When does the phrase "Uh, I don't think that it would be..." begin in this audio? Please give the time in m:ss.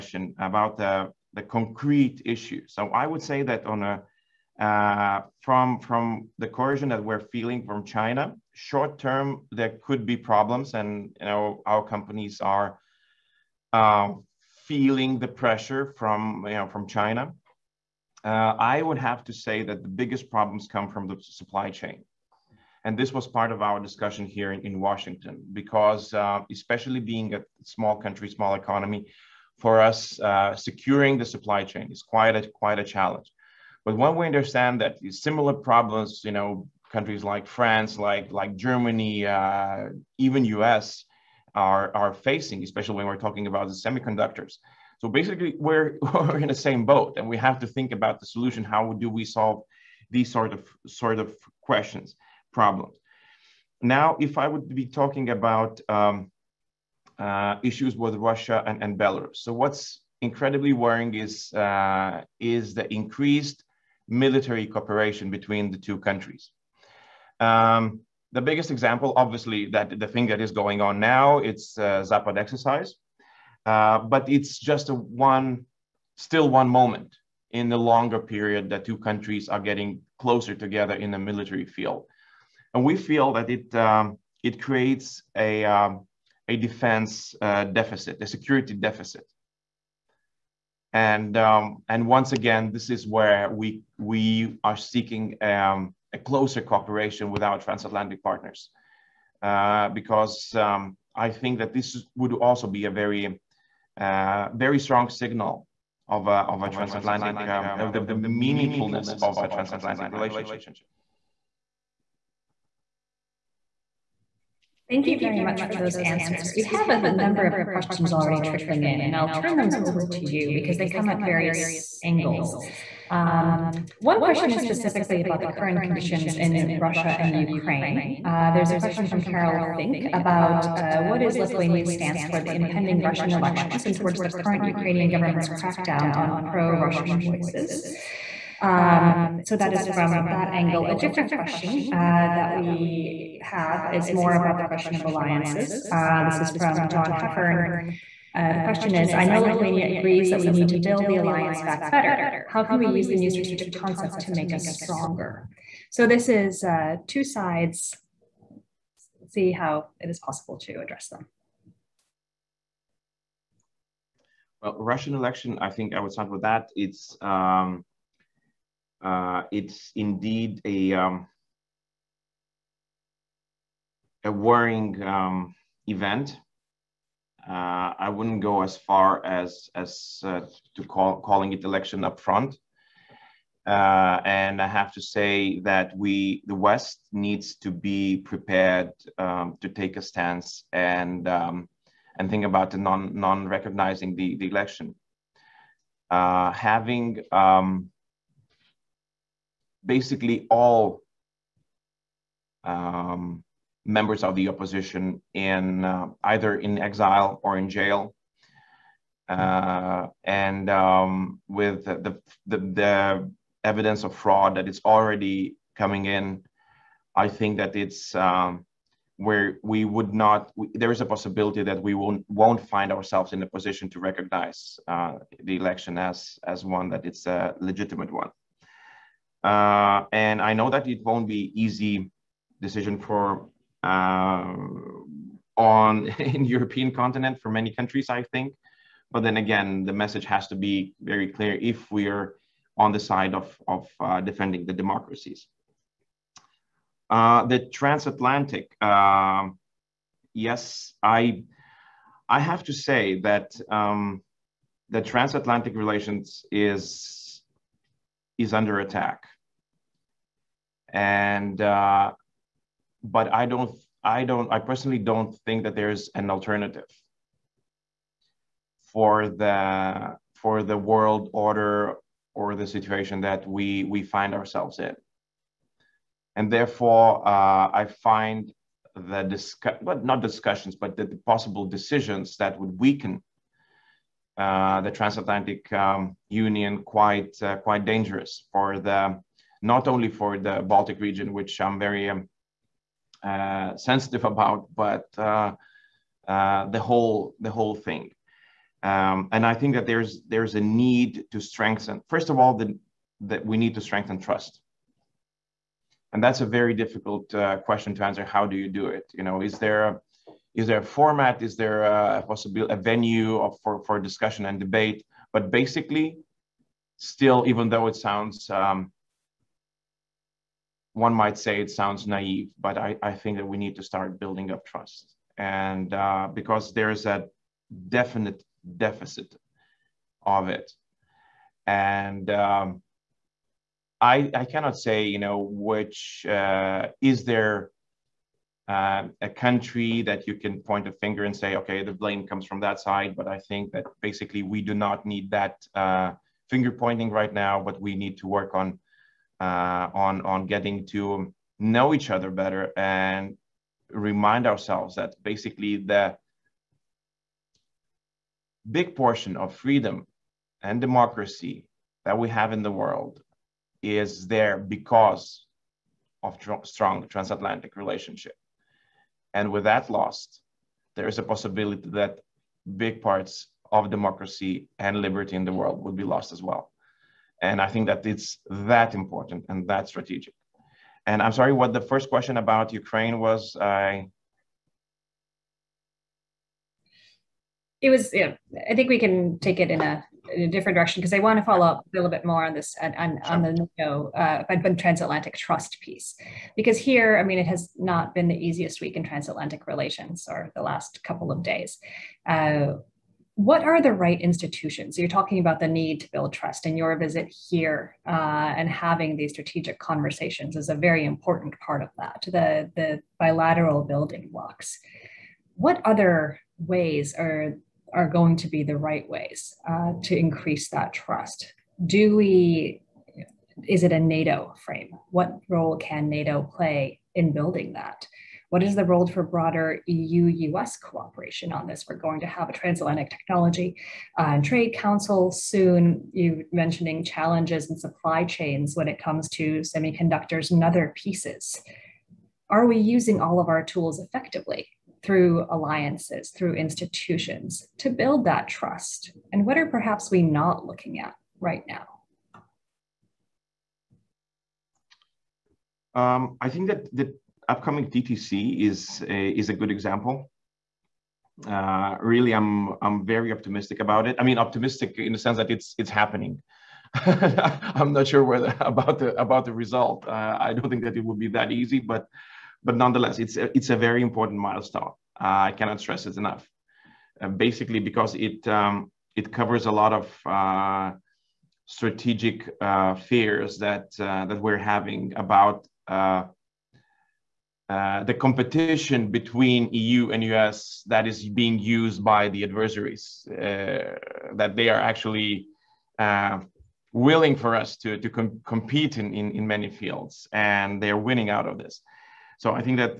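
7:50.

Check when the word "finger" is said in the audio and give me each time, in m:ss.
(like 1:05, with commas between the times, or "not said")
5:40, 5:46.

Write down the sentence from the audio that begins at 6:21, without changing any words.
And I'm sorry, what the first question about Ukraine was?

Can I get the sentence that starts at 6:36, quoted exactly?
Because here, I mean, it has not been the easiest week in transatlantic relations or the last couple of days.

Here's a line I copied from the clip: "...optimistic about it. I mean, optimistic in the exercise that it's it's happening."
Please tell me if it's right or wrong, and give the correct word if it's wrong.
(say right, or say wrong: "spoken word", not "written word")
wrong: "sense", not "exercise".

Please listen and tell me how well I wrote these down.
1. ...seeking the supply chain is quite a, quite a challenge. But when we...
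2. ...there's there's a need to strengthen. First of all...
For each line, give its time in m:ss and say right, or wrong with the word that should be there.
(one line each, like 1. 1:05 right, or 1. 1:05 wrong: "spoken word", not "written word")
1. 0:30 wrong: "securing", not "seeking"
2. 4:59 right.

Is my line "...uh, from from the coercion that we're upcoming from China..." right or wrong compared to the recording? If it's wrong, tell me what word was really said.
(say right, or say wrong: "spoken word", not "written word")
wrong: "feeling", not "upcoming".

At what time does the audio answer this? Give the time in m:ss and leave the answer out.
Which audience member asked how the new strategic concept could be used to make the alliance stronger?
2:26.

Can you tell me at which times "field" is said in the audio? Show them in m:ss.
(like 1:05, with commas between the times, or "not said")
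1:21, 8:19.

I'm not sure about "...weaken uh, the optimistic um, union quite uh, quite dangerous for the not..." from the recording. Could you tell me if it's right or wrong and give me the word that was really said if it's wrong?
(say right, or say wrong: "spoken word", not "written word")
wrong: "transatlantic", not "optimistic".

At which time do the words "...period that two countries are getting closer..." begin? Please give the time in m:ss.
1:18.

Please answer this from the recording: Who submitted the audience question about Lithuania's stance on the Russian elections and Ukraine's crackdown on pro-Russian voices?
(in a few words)
Carol Fink.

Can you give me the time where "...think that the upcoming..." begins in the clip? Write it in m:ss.
7:36.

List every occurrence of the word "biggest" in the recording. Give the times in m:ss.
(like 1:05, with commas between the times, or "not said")
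0:19, 1:08.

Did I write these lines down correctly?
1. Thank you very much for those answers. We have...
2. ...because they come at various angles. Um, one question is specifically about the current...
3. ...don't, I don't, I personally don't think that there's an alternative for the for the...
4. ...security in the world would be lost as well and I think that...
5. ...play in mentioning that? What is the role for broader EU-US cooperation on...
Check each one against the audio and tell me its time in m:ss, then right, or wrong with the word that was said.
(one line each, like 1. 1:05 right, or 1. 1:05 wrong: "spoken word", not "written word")
1. 1:54 right
2. 2:00 right
3. 4:23 right
4. 6:15 wrong: "liberty", not "security"
5. 7:06 wrong: "building", not "mentioning".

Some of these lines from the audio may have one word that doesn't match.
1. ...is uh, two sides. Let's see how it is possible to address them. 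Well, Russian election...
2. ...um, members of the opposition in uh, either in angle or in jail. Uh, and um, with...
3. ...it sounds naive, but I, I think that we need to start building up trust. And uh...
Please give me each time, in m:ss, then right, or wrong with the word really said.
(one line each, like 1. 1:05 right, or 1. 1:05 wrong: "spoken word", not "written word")
1. 2:36 right
2. 3:22 wrong: "exile", not "angle"
3. 5:21 right.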